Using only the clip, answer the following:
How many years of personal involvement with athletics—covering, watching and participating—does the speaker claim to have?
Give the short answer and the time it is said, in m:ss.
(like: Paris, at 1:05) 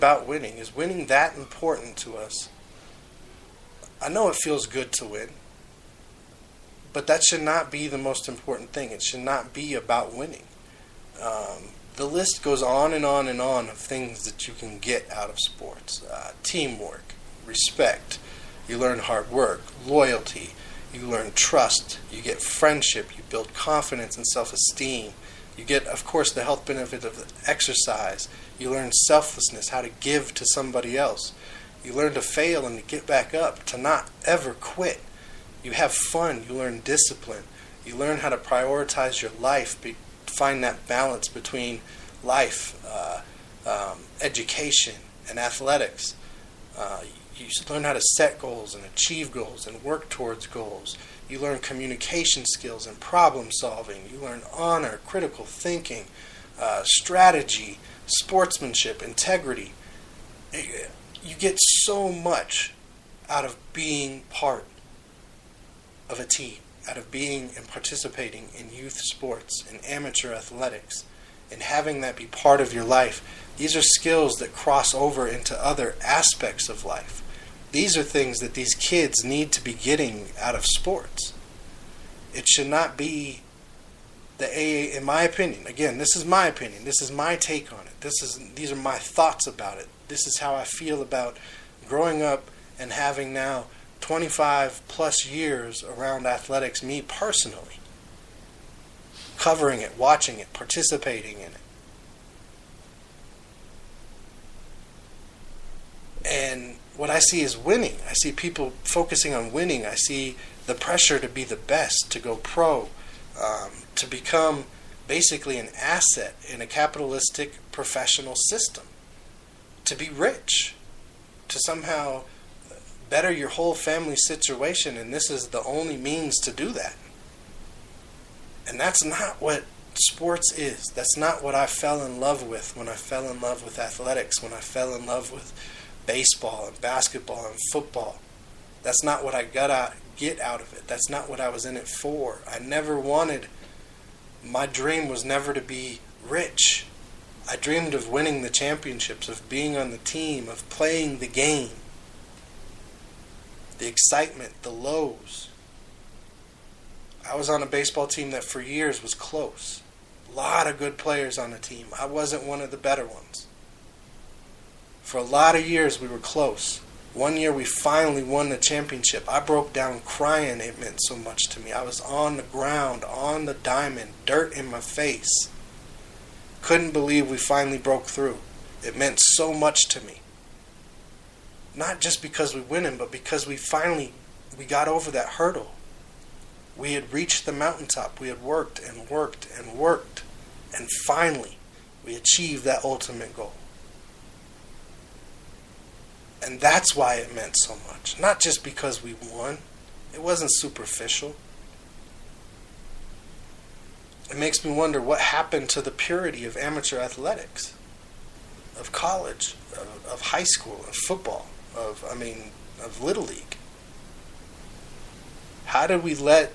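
25 plus years, at 1:34.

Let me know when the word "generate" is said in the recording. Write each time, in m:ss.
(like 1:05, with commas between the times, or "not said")
not said.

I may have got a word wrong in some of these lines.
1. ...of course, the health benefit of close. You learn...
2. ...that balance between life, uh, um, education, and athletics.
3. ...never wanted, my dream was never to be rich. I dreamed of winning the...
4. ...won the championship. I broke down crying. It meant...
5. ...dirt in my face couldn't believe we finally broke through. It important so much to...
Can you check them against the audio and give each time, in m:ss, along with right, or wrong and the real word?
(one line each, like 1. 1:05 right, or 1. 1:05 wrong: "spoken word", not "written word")
1. 0:25 wrong: "exercise", not "close"
2. 0:40 right
3. 2:22 right
4. 2:48 right
5. 2:54 wrong: "meant", not "important".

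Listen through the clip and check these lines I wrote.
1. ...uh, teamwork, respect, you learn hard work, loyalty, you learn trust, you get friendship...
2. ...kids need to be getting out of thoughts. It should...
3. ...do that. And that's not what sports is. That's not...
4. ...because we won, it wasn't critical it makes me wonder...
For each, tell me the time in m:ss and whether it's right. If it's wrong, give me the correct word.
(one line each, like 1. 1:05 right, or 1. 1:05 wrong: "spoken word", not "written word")
1. 0:16 right
2. 1:18 wrong: "sports", not "thoughts"
3. 2:06 right
4. 3:18 wrong: "superficial", not "critical".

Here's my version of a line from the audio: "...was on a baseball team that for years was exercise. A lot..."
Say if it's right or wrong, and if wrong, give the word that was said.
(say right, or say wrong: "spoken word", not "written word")
wrong: "close", not "exercise".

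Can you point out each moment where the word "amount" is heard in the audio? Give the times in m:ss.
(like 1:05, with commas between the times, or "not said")
not said.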